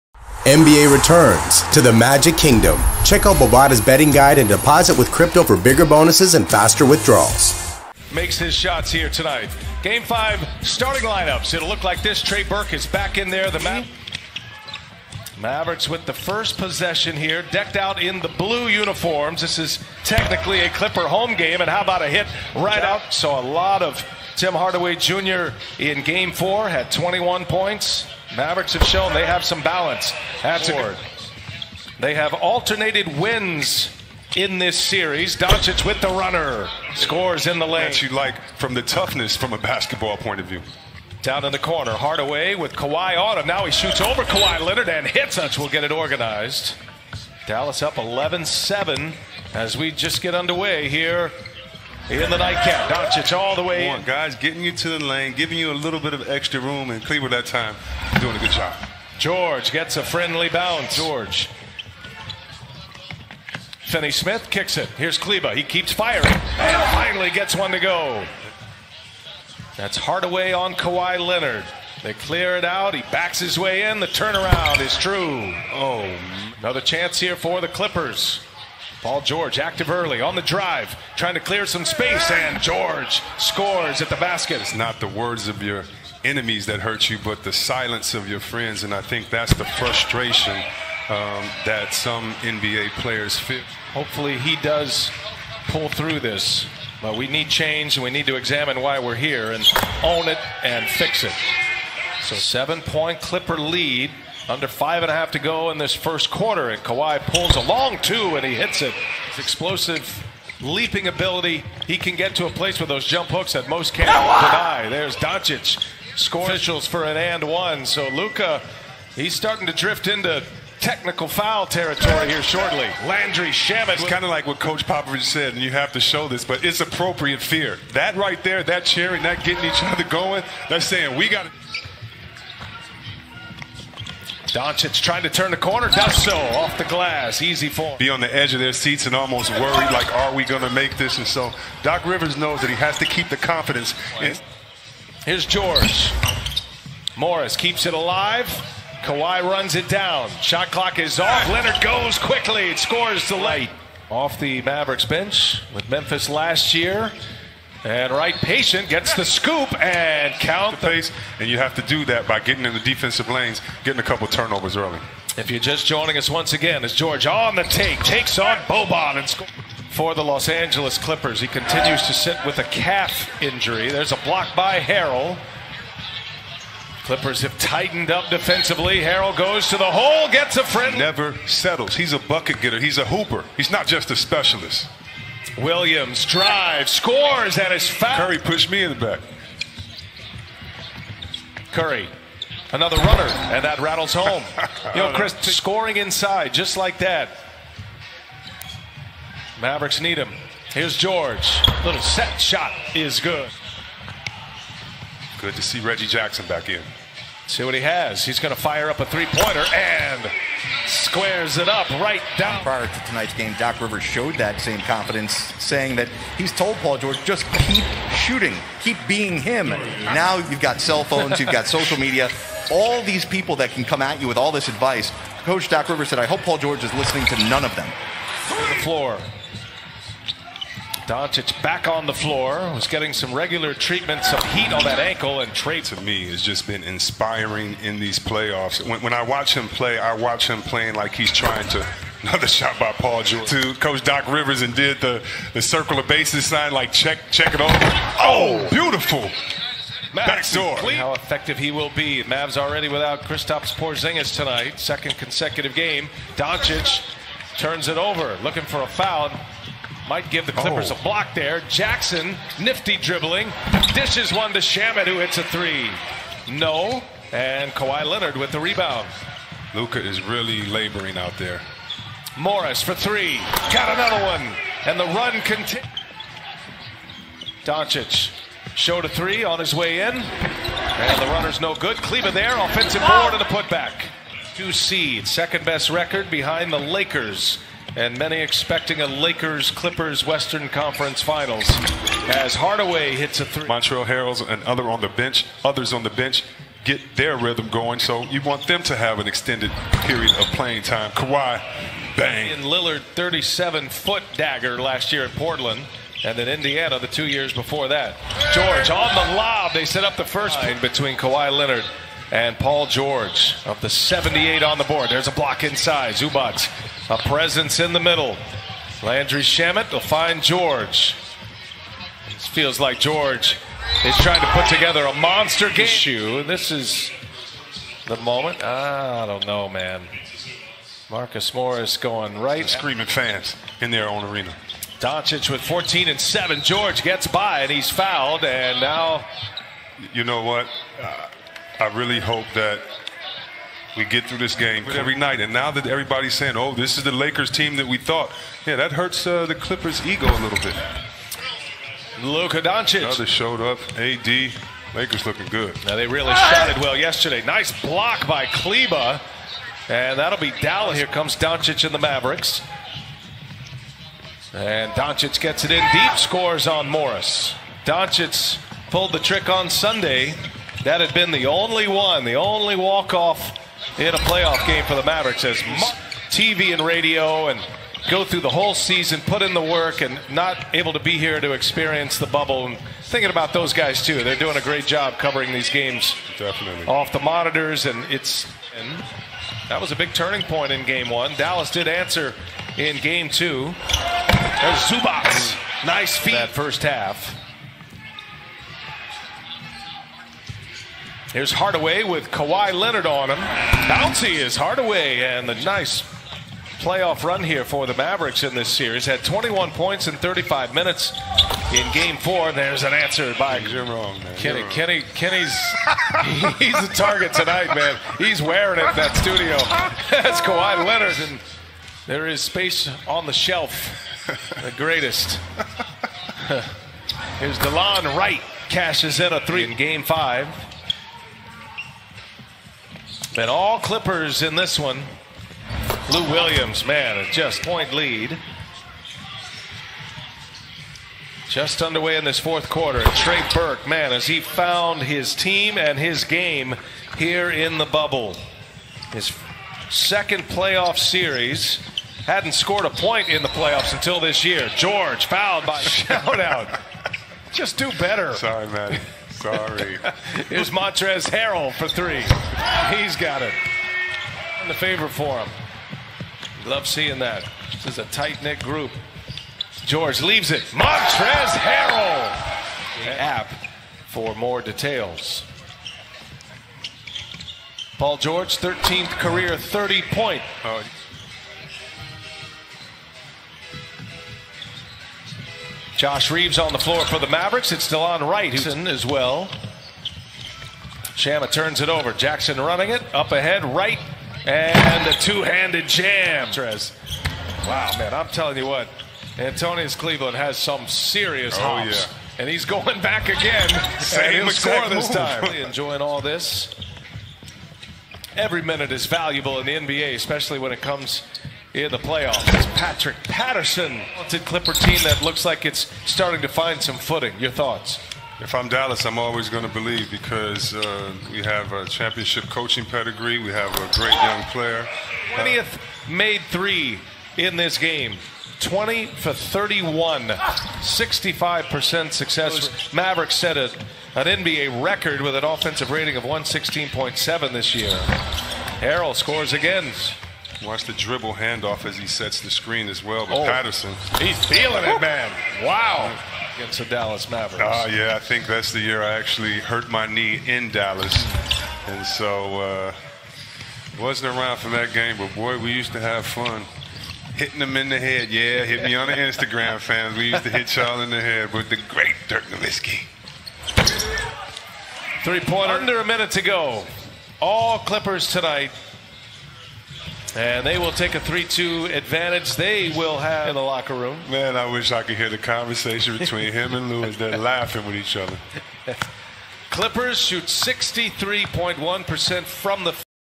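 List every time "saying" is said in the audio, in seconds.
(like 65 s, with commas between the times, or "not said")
130 s, 215 s, 346 s.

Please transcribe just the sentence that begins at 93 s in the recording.
Hopefully, he does pull through this.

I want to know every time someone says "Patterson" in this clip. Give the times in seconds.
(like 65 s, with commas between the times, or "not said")
513 s, 543 s.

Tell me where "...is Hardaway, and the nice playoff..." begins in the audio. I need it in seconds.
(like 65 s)
404 s.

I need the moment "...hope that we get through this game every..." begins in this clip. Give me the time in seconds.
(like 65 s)
342 s.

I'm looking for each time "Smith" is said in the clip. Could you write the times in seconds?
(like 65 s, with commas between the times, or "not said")
64 s.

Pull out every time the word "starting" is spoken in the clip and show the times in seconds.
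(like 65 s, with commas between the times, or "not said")
10 s, 119 s, 516 s.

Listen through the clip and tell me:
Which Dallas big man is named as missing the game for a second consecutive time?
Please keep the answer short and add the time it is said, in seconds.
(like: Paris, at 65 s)
Kristaps Porzingis, at 253 s.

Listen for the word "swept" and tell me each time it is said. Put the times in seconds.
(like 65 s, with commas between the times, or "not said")
not said.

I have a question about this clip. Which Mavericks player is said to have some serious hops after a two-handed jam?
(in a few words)
Antonius Cleveland.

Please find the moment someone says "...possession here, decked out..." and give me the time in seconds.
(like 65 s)
16 s.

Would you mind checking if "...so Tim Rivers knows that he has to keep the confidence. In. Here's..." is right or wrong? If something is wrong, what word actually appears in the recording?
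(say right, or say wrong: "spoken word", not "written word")
wrong: "Doc", not "Tim".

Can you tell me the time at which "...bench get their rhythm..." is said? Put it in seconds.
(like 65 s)
296 s.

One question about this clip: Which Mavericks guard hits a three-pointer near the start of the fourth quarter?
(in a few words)
Delon Wright.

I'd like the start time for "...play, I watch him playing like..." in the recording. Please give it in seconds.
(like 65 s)
239 s.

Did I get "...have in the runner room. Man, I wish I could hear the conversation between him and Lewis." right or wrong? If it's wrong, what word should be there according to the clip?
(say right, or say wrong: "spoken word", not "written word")
wrong: "locker", not "runner".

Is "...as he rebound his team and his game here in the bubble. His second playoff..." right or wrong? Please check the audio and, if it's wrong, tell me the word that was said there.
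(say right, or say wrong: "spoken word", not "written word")
wrong: "found", not "rebound".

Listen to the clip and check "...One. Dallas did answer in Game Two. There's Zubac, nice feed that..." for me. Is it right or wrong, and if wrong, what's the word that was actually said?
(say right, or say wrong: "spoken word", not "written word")
right.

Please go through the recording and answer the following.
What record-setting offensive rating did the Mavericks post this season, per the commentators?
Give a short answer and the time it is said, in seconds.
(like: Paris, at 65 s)
116.7, at 536 s.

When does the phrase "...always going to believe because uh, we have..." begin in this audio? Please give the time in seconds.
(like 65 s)
519 s.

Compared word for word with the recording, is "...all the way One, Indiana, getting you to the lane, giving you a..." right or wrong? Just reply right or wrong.
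wrong.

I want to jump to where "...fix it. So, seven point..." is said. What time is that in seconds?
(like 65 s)
100 s.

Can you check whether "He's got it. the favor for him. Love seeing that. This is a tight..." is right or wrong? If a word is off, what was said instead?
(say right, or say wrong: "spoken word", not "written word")
right.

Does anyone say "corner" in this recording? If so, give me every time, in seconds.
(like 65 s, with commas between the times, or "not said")
41 s, 135 s.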